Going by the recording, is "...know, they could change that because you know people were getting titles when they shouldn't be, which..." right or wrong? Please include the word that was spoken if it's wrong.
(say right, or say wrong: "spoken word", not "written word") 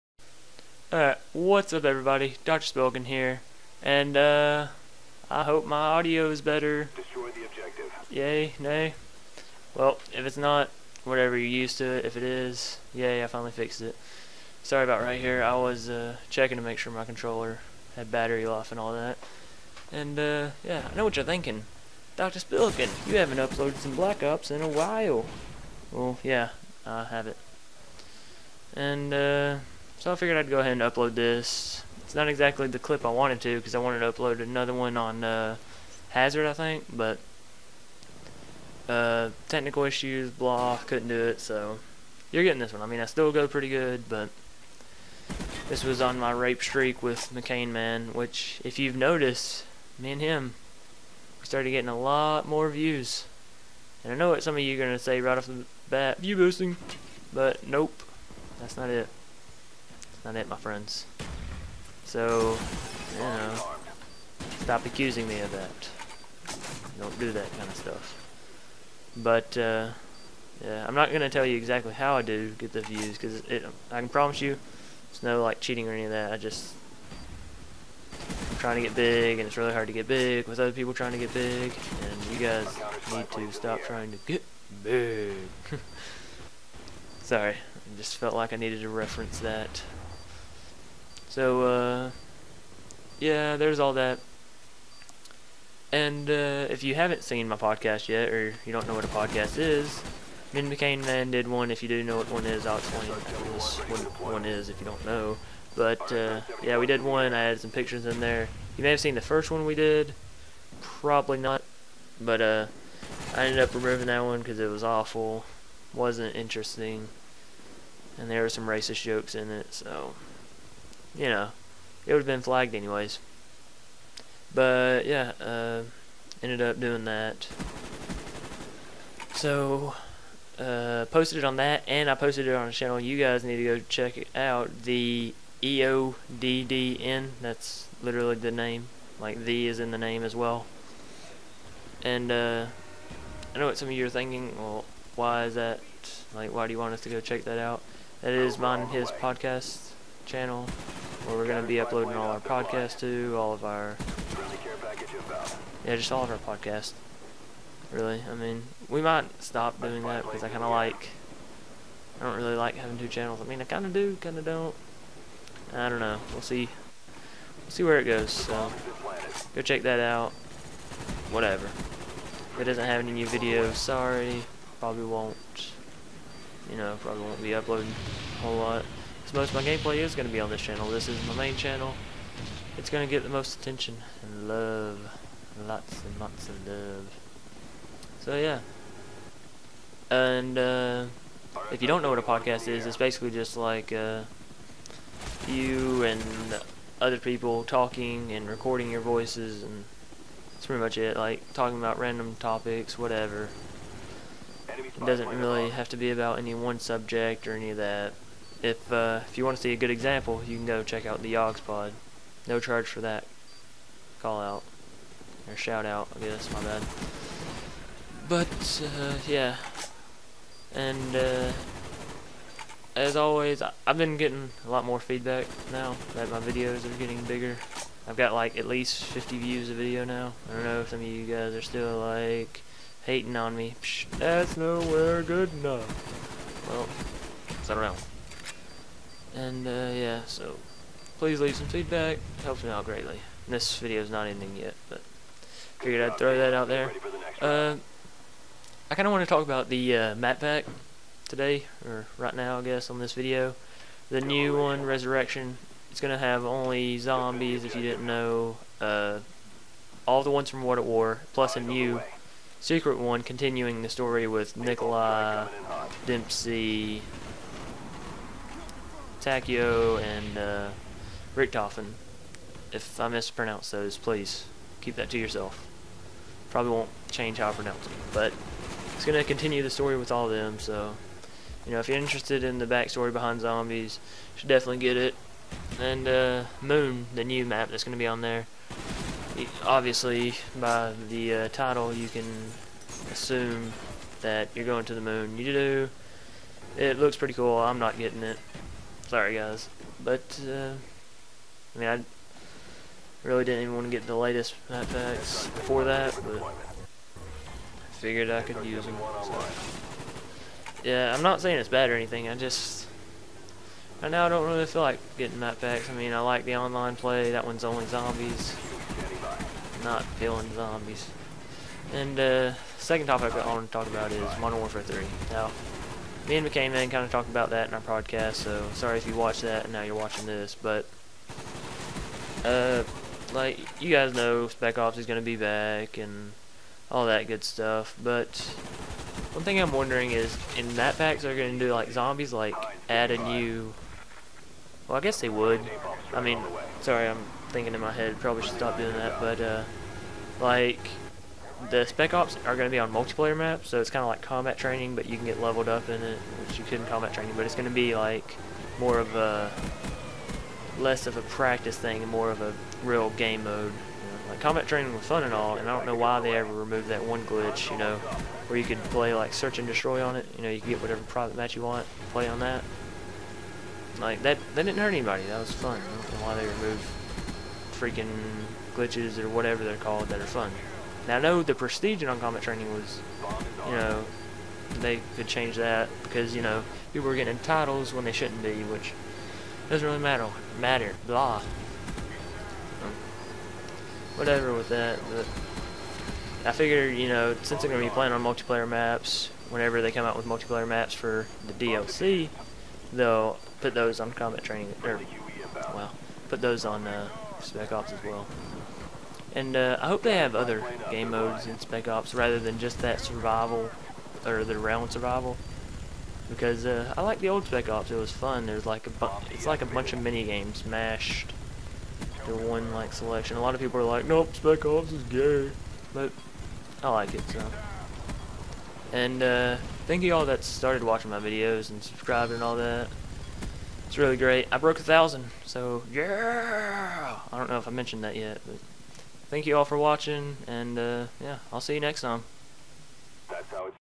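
right.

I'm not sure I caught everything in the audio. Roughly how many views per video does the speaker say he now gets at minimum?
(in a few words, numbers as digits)
50.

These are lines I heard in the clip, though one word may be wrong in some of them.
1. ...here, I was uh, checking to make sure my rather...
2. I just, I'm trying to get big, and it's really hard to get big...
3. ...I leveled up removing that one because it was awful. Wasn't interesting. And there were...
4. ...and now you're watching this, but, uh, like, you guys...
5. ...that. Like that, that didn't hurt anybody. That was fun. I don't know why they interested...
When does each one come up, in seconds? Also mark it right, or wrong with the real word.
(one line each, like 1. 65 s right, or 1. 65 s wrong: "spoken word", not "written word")
1. 15 s wrong: "controller", not "rather"
2. 76 s right
3. 113 s wrong: "ended", not "leveled"
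4. 329 s right
5. 372 s wrong: "removed", not "interested".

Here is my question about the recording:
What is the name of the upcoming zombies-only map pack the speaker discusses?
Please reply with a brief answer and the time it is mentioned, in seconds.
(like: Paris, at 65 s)
Resurrection, at 254 s.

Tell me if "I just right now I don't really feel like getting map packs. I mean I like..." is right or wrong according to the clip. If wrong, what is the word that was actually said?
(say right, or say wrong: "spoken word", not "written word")
right.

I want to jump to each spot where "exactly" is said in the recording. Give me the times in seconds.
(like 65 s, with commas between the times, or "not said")
32 s, 71 s.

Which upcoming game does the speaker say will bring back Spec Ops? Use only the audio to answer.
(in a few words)
Modern Warfare 3.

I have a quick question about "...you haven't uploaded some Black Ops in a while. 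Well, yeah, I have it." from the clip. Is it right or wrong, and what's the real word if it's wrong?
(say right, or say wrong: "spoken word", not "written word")
right.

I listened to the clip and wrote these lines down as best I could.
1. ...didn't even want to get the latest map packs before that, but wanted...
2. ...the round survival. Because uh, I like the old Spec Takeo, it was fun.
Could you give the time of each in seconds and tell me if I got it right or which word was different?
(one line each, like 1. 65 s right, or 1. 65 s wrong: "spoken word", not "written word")
1. 303 s wrong: "figured", not "wanted"
2. 414 s wrong: "Ops", not "Takeo".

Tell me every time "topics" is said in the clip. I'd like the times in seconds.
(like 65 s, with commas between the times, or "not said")
202 s, 323 s.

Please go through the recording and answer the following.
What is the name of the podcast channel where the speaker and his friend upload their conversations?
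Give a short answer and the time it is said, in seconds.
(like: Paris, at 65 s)
The EODDN, at 134 s.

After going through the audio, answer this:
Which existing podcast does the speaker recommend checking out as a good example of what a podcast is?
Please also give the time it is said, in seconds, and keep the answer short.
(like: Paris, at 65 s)
Yogs Pod, at 211 s.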